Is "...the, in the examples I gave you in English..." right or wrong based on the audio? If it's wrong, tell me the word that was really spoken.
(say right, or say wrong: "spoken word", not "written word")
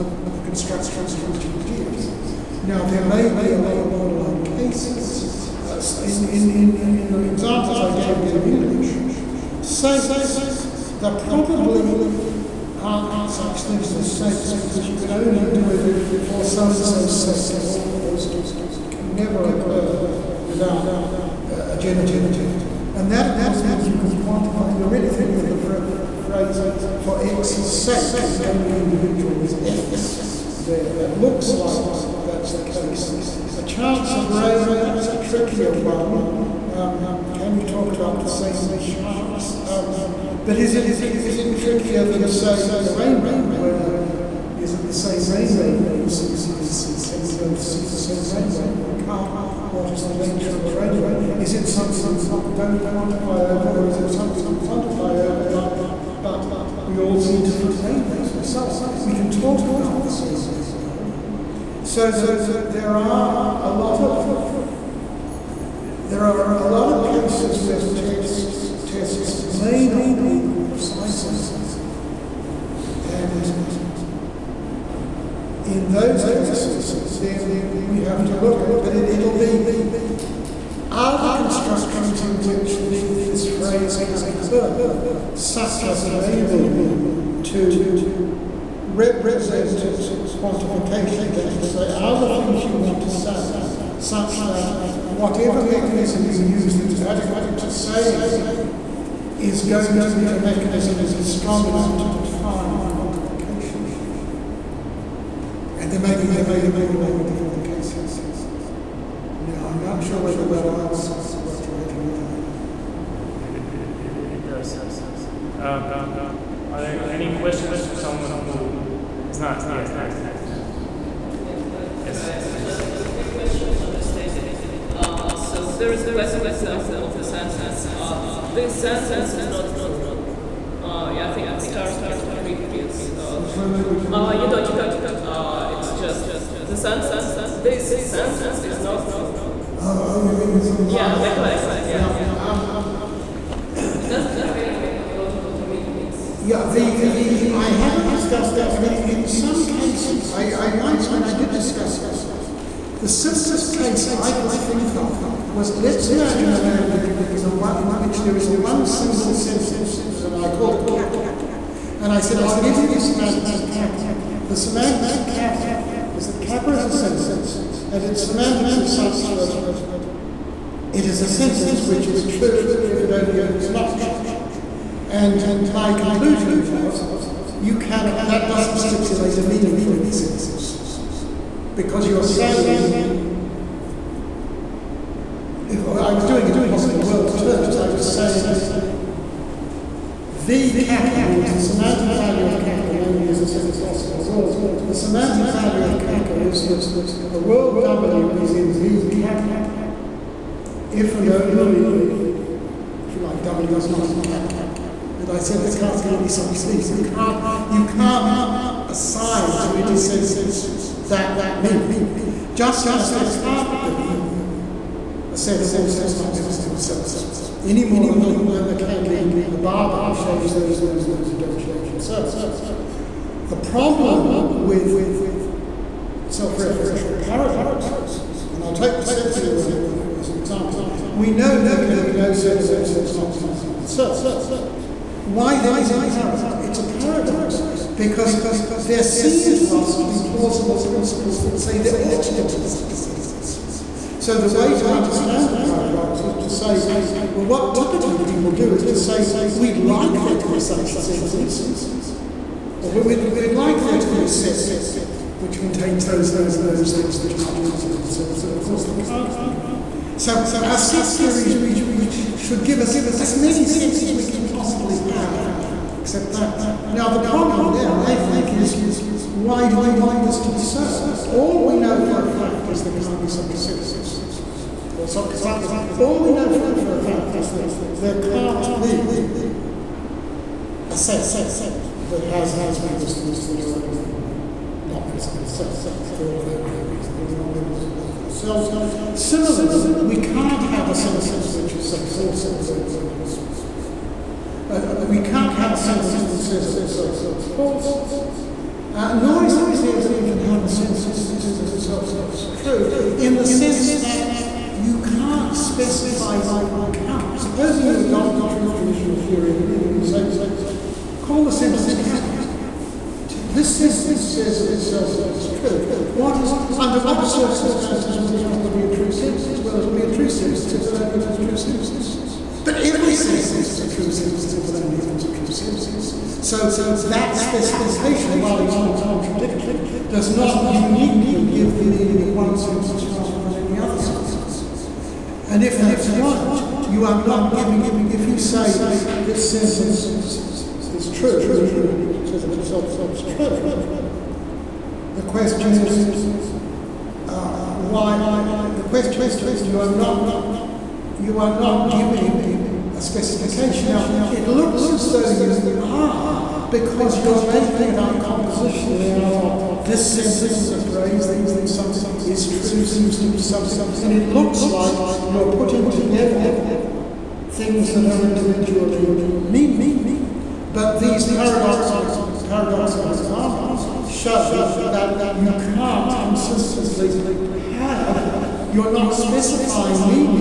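right.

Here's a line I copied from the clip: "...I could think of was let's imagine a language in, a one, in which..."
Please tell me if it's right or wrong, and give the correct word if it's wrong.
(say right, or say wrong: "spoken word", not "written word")
right.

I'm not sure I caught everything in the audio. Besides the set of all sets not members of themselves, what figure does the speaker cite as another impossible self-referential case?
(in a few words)
a barber.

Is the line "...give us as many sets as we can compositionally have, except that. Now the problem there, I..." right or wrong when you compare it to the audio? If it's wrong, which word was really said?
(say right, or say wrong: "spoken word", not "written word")
wrong: "possibly", not "compositionally".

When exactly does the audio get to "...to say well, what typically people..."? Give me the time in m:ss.
4:06.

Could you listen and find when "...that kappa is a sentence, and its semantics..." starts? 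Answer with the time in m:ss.
2:46.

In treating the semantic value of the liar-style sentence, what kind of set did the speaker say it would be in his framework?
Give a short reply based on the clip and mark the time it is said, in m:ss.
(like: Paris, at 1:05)
a set of possible worlds, at 3:13.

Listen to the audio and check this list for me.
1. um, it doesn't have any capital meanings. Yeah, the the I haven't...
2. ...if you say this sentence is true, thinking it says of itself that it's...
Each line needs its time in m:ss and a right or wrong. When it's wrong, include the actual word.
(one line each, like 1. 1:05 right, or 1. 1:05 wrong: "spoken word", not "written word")
1. 2:22 wrong: "logical", not "capital"
2. 5:38 wrong: "meaning", not "thinking".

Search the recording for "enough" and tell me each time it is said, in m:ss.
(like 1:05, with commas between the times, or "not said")
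1:11, 1:41.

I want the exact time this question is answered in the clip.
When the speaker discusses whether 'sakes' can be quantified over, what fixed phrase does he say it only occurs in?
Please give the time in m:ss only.
0:27.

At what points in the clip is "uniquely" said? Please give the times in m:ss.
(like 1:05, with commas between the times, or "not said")
5:30.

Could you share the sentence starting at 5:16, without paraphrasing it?
What is, under what circumstances will capital be a true sentence?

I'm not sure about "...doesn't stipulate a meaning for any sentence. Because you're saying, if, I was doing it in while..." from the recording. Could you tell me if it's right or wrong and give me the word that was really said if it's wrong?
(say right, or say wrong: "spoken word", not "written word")
wrong: "possible", not "while".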